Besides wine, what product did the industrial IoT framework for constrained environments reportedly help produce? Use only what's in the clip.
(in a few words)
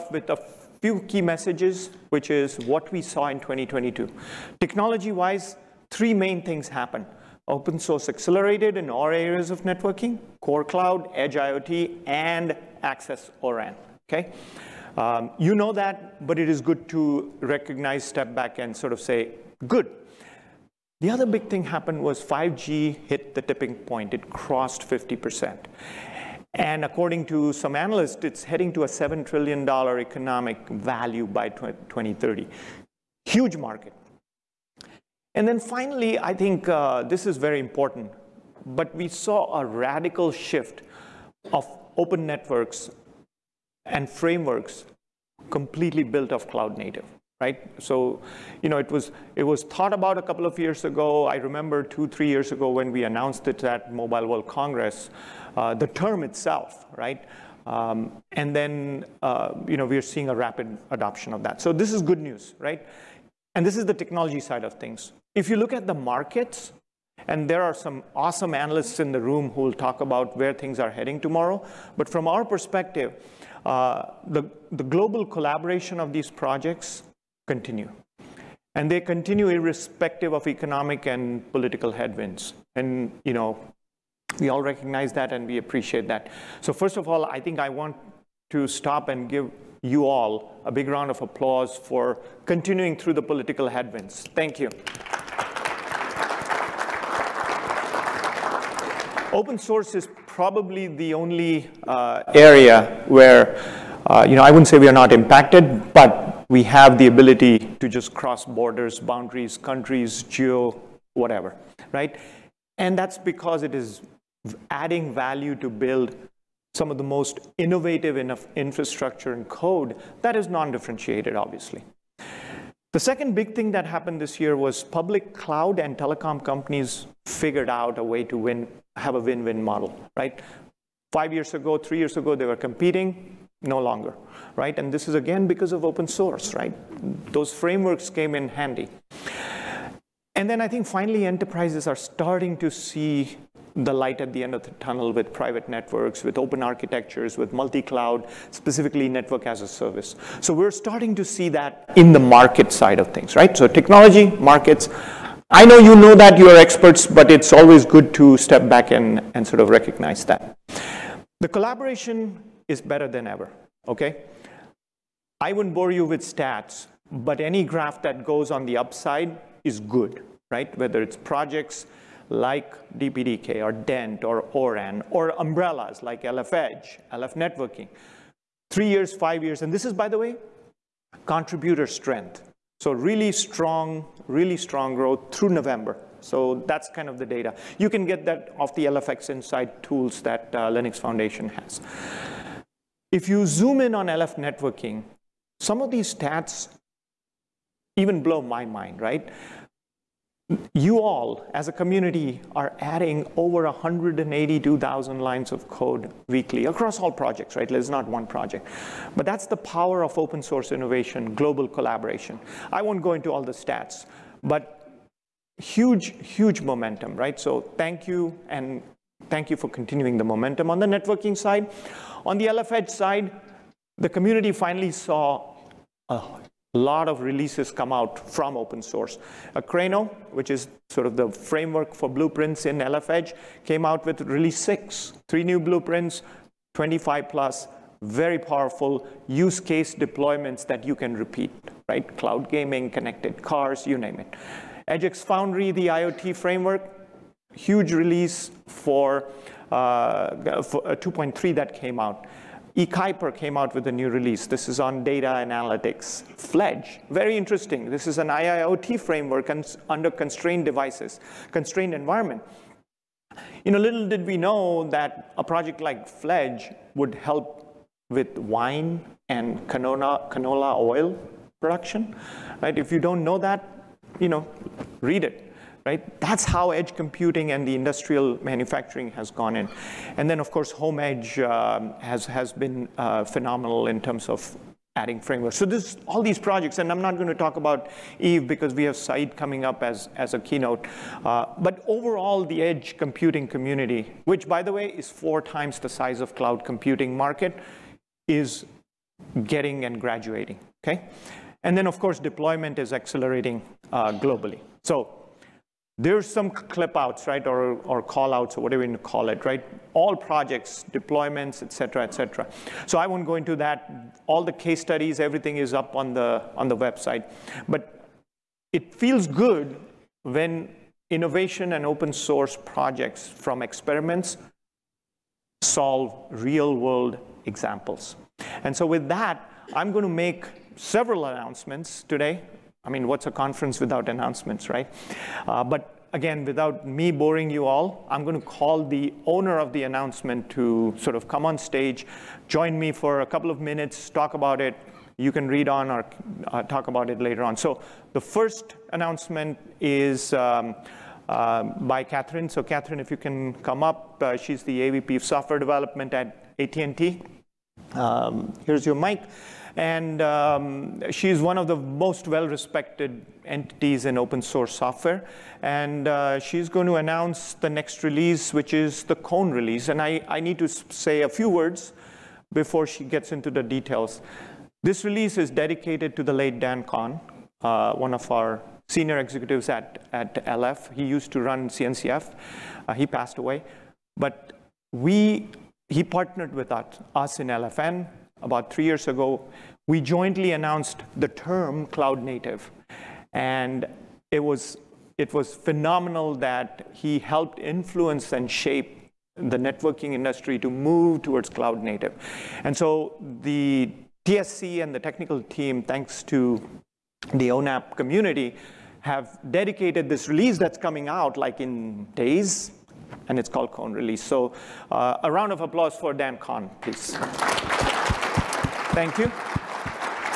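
canola oil.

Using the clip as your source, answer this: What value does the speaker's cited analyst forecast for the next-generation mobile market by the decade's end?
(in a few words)
$7 trillion.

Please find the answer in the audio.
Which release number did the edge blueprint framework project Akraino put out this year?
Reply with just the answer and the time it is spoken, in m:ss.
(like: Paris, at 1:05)
6, at 3:54.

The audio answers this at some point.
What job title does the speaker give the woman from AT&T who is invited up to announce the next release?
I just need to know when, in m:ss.
5:54.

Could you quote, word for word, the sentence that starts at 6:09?
And I, I need to say a few words before she gets into the details.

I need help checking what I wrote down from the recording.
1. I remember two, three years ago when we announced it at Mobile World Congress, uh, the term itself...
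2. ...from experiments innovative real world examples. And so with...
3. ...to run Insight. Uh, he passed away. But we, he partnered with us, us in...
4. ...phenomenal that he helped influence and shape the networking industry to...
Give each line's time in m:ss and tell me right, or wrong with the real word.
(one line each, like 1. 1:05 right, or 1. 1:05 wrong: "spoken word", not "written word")
1. 0:51 right
2. 5:23 wrong: "solve", not "innovative"
3. 6:21 wrong: "CNCF", not "Insight"
4. 6:35 right.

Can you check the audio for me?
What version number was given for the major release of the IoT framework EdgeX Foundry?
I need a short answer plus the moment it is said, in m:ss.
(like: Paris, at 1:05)
2.3, at 4:10.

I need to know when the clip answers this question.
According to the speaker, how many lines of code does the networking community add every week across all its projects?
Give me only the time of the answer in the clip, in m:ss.
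3:23.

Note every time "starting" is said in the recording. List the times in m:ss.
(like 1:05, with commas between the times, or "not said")
2:21, 2:30.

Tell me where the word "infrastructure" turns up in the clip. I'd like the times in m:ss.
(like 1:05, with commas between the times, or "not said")
1:58.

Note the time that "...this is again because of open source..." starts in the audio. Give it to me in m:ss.
2:14.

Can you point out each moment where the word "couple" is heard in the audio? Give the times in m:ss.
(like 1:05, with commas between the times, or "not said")
0:50, 5:43.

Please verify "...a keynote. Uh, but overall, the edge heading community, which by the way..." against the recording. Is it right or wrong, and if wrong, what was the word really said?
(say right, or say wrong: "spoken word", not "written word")
wrong: "computing", not "heading".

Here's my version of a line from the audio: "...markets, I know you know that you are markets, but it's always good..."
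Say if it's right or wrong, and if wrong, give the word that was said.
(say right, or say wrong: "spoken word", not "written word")
wrong: "experts", not "markets".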